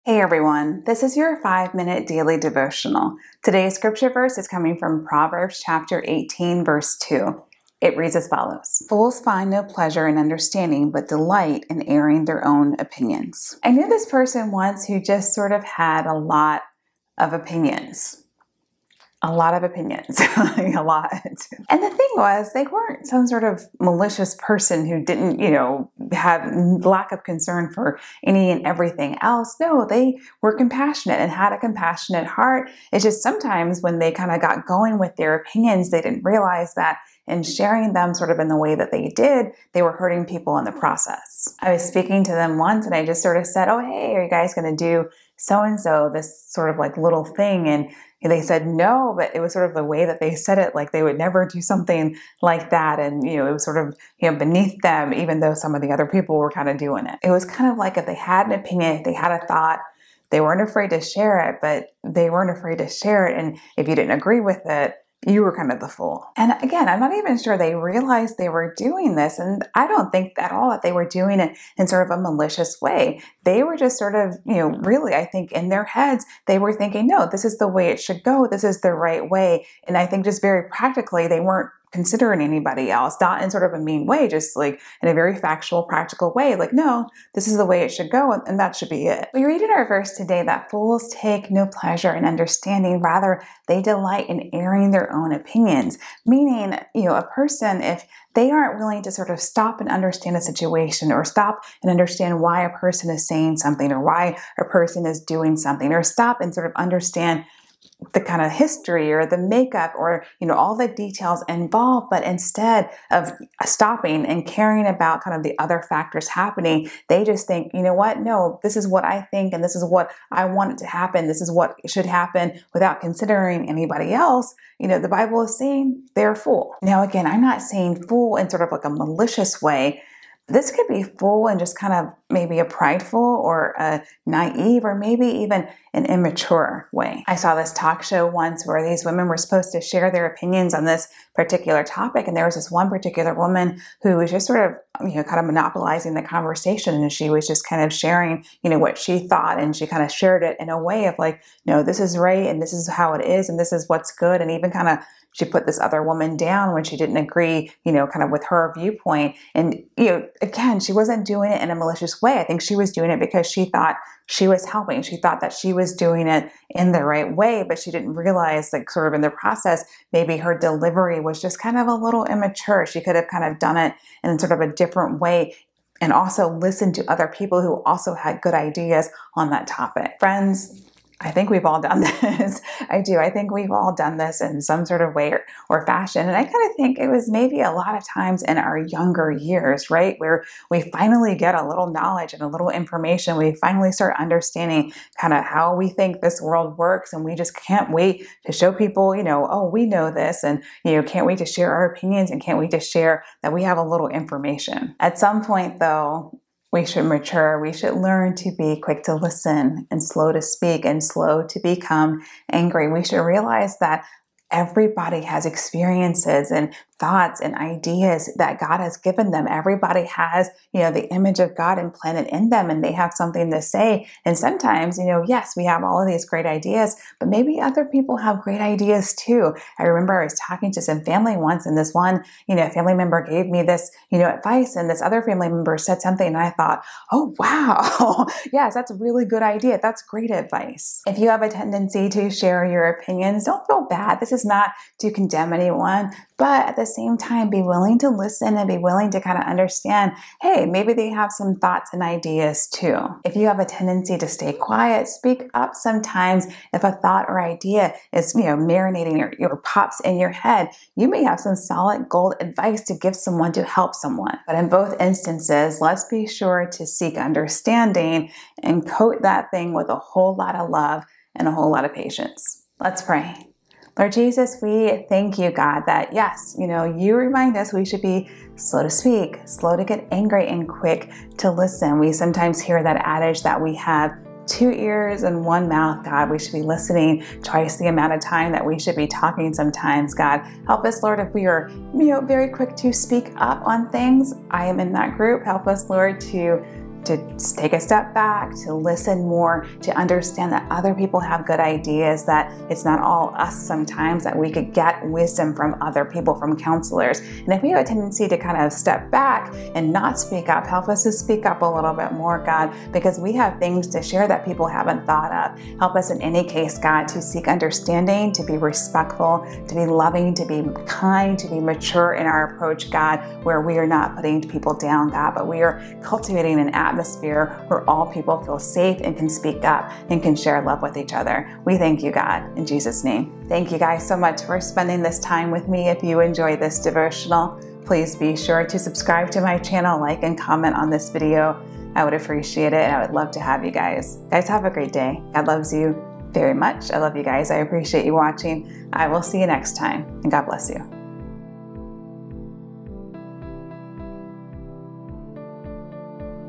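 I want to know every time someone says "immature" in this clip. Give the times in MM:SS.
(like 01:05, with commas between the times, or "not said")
02:16, 02:52.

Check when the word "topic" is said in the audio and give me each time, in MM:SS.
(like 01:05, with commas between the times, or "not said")
02:21, 02:59.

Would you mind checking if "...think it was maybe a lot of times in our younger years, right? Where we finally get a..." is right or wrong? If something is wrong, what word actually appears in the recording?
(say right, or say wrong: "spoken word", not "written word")
right.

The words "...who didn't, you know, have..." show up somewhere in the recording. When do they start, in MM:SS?
00:24.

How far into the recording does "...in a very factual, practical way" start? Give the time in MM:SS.
01:25.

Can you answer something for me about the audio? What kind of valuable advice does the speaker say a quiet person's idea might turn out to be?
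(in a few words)
Solid gold.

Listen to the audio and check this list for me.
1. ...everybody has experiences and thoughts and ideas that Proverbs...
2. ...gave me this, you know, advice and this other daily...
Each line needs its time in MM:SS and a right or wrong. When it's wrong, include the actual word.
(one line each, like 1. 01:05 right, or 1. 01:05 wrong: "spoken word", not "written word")
1. 03:34 wrong: "God", not "Proverbs"
2. 03:53 wrong: "family", not "daily".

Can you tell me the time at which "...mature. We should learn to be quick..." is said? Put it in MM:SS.
03:27.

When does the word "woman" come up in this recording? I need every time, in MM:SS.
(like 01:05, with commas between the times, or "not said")
02:23, 02:36.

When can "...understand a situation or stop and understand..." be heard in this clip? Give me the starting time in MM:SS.
01:39.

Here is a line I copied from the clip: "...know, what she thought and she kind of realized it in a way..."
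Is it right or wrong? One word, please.
wrong.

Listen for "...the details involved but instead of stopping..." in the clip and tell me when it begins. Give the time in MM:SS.
01:50.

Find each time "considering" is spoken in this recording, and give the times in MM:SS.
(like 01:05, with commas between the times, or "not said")
01:21, 02:03.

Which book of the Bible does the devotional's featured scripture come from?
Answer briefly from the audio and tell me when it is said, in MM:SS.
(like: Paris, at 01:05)
Proverbs, at 00:05.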